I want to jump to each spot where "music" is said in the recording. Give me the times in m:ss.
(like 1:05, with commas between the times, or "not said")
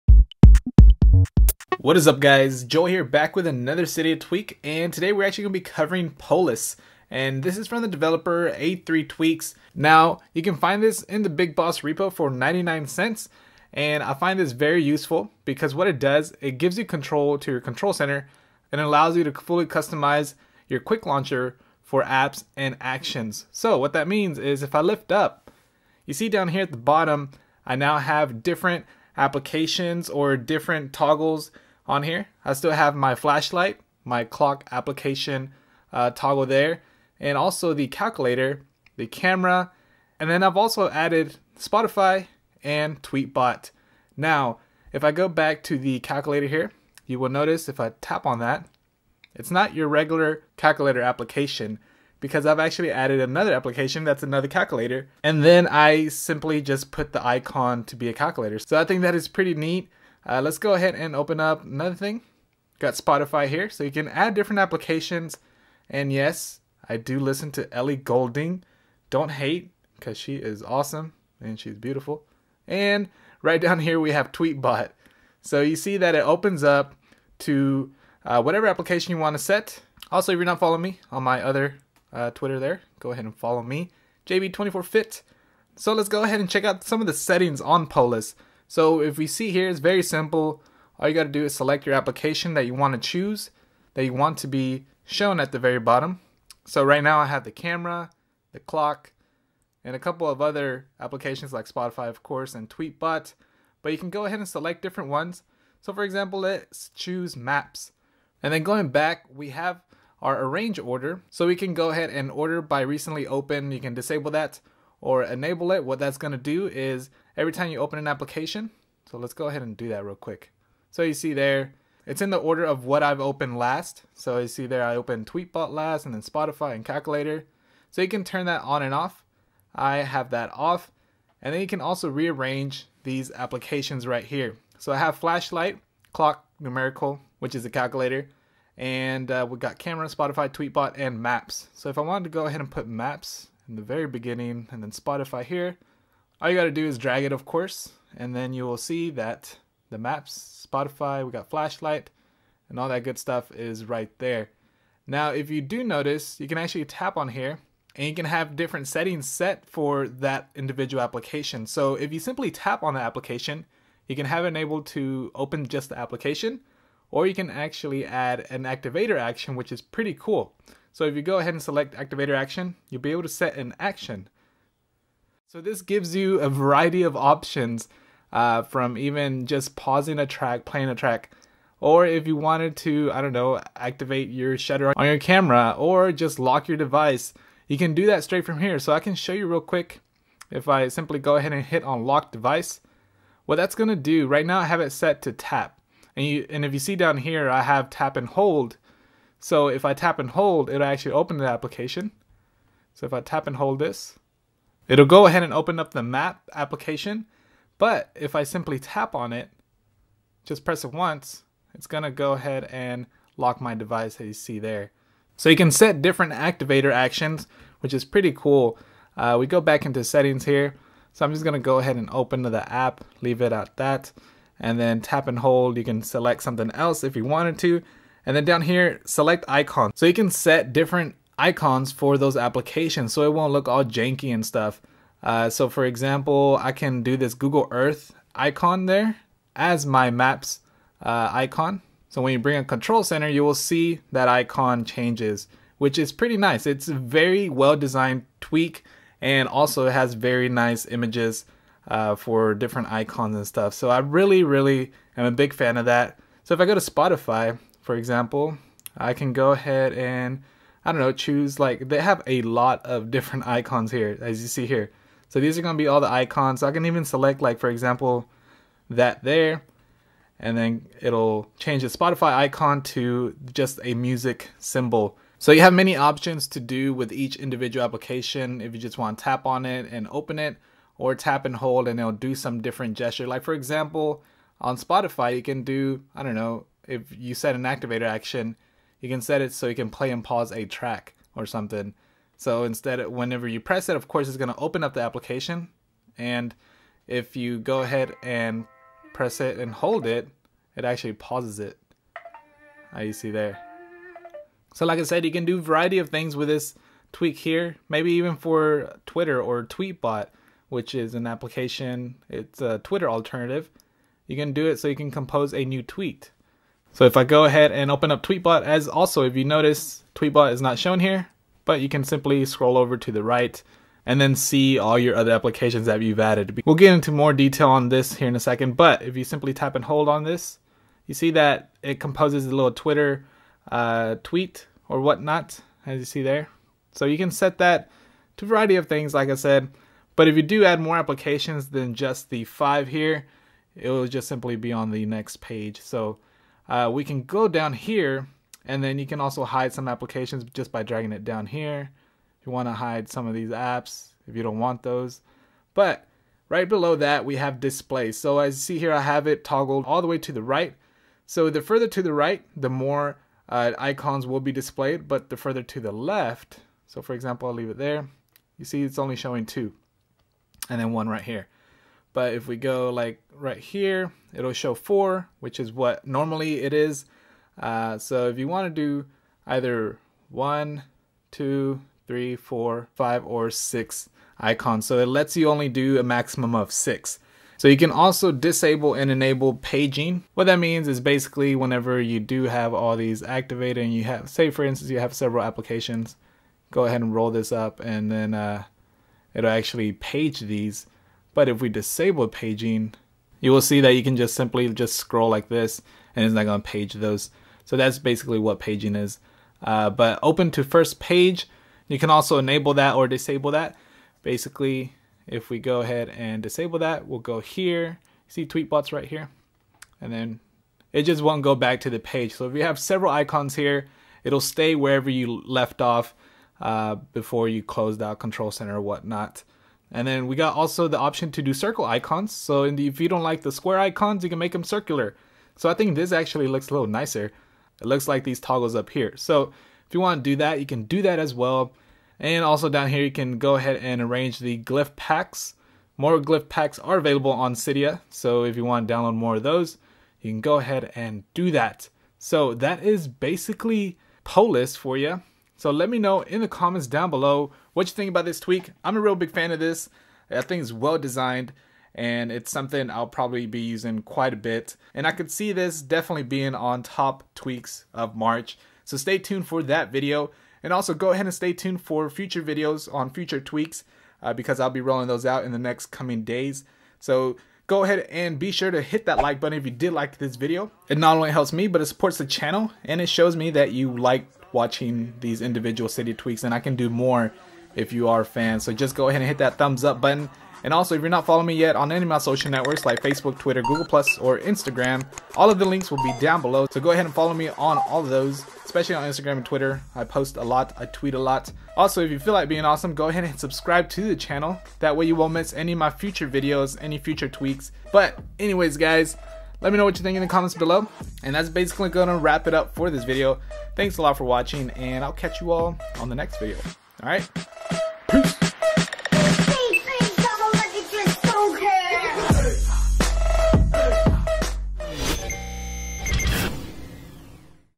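4:33.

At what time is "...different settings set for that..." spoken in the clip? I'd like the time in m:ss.
2:38.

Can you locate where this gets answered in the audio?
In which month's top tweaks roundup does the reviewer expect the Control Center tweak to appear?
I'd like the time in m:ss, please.
7:48.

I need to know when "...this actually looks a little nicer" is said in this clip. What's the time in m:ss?
7:15.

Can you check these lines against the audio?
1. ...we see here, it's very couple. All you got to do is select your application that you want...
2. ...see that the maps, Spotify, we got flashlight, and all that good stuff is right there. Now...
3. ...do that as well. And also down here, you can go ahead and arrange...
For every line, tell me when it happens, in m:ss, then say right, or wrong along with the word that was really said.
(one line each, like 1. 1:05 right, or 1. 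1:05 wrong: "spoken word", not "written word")
1. 1:29 wrong: "simple", not "couple"
2. 2:28 right
3. 7:20 right.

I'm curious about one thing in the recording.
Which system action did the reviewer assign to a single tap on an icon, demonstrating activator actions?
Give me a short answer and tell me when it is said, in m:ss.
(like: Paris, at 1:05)
Lock device, at 3:12.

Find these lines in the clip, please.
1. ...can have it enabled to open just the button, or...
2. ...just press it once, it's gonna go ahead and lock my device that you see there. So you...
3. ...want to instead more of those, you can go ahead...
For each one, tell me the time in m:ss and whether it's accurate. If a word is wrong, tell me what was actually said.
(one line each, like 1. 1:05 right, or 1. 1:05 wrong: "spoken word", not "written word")
1. 2:44 wrong: "application", not "button"
2. 3:30 right
3. 7:28 wrong: "download", not "instead".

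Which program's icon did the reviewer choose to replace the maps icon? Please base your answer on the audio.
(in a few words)
Google Earth.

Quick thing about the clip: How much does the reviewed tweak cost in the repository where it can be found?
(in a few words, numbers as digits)
99 cents.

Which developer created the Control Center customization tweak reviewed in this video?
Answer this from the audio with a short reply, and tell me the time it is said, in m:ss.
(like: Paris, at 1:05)
A3Tweaks, at 0:08.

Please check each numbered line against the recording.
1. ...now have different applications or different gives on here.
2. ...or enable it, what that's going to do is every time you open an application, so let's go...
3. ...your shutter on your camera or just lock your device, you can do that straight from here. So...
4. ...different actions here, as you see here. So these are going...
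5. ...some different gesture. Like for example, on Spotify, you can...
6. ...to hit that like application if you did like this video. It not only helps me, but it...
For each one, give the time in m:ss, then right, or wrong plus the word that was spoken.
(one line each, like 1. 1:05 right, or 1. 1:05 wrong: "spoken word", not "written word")
1. 0:27 wrong: "toggles", not "gives"
2. 1:55 right
3. 3:04 right
4. 4:23 wrong: "icons", not "actions"
5. 4:42 right
6. 7:58 wrong: "button", not "application".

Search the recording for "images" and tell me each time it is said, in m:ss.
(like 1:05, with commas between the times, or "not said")
4:10.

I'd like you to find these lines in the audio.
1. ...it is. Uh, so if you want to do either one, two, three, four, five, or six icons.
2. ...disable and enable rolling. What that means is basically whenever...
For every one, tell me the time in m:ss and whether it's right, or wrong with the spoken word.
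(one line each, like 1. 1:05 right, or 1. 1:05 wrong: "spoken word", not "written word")
1. 6:16 right
2. 6:28 wrong: "paging", not "rolling".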